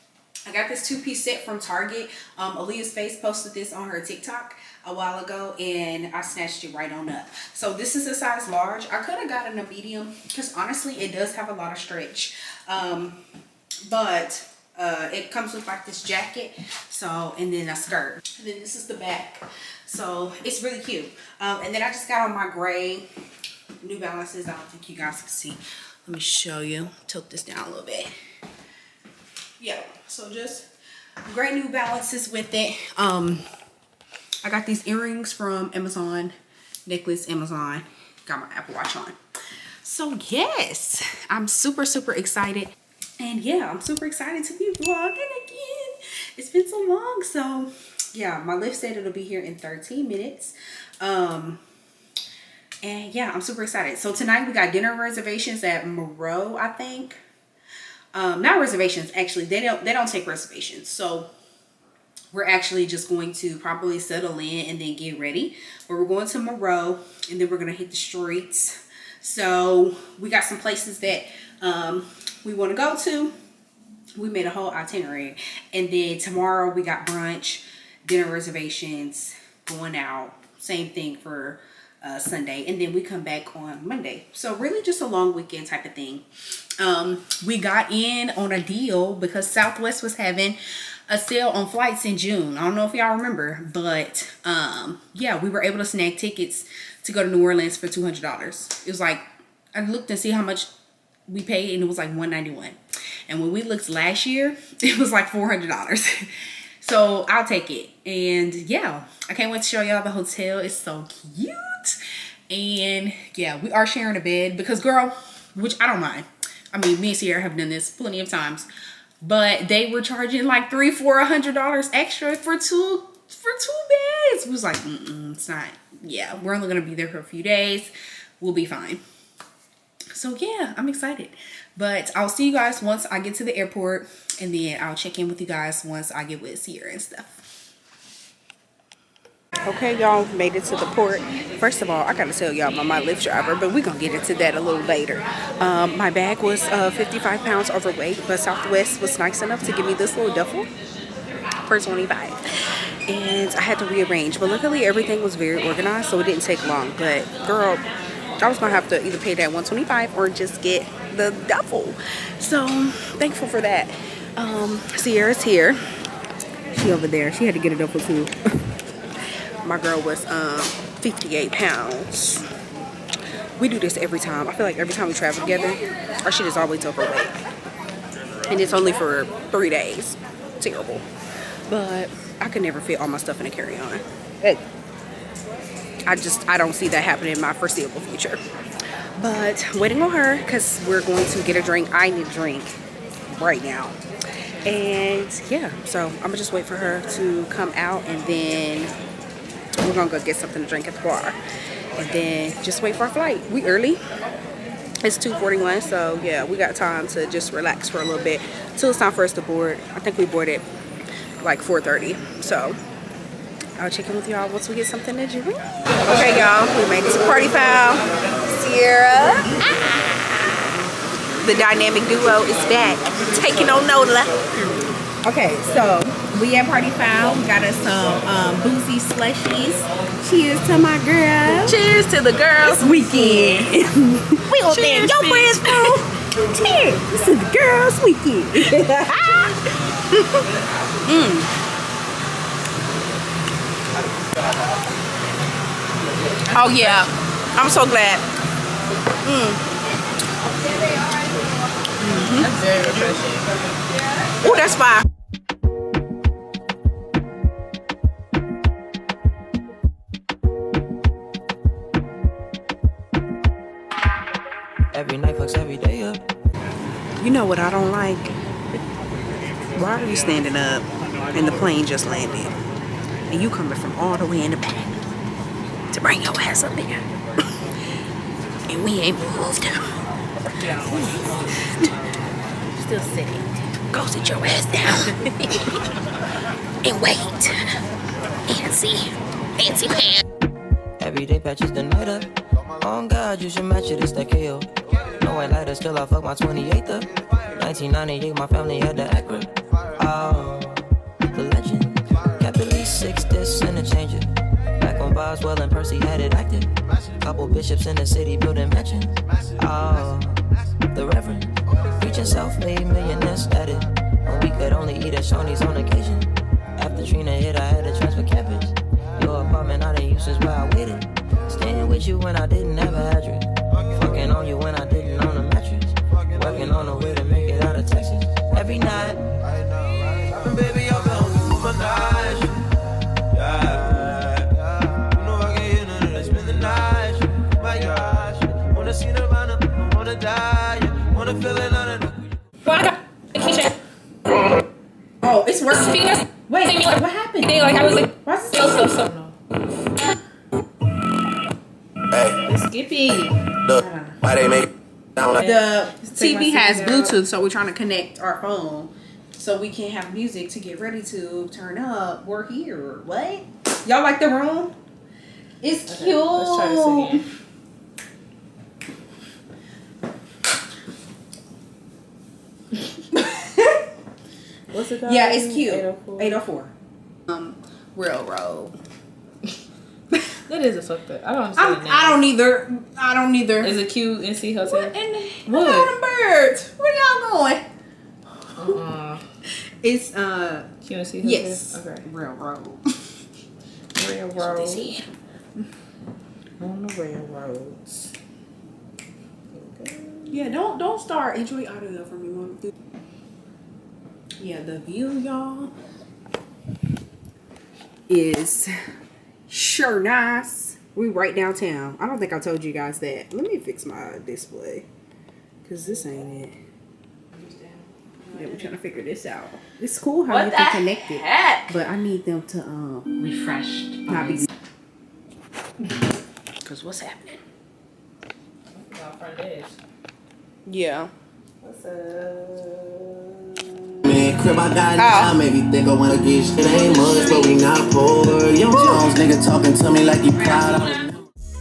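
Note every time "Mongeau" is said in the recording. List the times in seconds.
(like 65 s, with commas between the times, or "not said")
not said.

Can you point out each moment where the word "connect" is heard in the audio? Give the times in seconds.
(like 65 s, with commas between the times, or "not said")
357 s, 420 s.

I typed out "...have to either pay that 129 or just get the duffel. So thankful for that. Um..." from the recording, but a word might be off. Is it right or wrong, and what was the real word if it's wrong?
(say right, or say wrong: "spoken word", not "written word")
wrong: "125", not "129".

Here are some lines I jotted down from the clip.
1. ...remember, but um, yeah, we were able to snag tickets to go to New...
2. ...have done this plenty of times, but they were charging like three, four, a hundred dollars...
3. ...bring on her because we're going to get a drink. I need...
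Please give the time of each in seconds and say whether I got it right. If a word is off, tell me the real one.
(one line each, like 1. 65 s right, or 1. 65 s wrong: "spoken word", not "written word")
1. 93 s right
2. 117 s right
3. 189 s wrong: "waiting", not "bring".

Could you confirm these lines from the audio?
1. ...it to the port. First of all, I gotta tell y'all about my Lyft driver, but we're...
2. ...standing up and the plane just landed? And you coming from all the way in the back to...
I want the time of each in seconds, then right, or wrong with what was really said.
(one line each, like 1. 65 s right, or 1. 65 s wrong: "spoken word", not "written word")
1. 140 s right
2. 270 s right.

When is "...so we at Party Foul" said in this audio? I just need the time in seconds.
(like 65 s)
225 s.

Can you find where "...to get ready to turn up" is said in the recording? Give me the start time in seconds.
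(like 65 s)
360 s.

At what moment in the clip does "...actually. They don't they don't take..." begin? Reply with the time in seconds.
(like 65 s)
59 s.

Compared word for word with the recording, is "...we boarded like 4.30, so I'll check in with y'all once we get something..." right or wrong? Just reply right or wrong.
right.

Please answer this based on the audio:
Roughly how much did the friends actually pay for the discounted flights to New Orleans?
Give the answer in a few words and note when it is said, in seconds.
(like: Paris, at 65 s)
191, at 102 s.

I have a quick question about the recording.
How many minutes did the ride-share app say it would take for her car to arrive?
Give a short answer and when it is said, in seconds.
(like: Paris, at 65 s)
13, at 49 s.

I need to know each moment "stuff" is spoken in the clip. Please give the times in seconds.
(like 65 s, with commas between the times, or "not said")
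137 s, 183 s.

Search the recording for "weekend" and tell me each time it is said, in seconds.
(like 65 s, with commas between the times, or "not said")
85 s, 232 s, 238 s.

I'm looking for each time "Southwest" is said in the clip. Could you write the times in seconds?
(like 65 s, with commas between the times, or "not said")
89 s, 148 s.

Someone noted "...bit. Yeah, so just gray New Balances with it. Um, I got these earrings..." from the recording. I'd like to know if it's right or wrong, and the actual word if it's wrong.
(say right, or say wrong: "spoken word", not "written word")
right.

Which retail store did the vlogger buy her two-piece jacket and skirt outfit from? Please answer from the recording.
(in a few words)
Target.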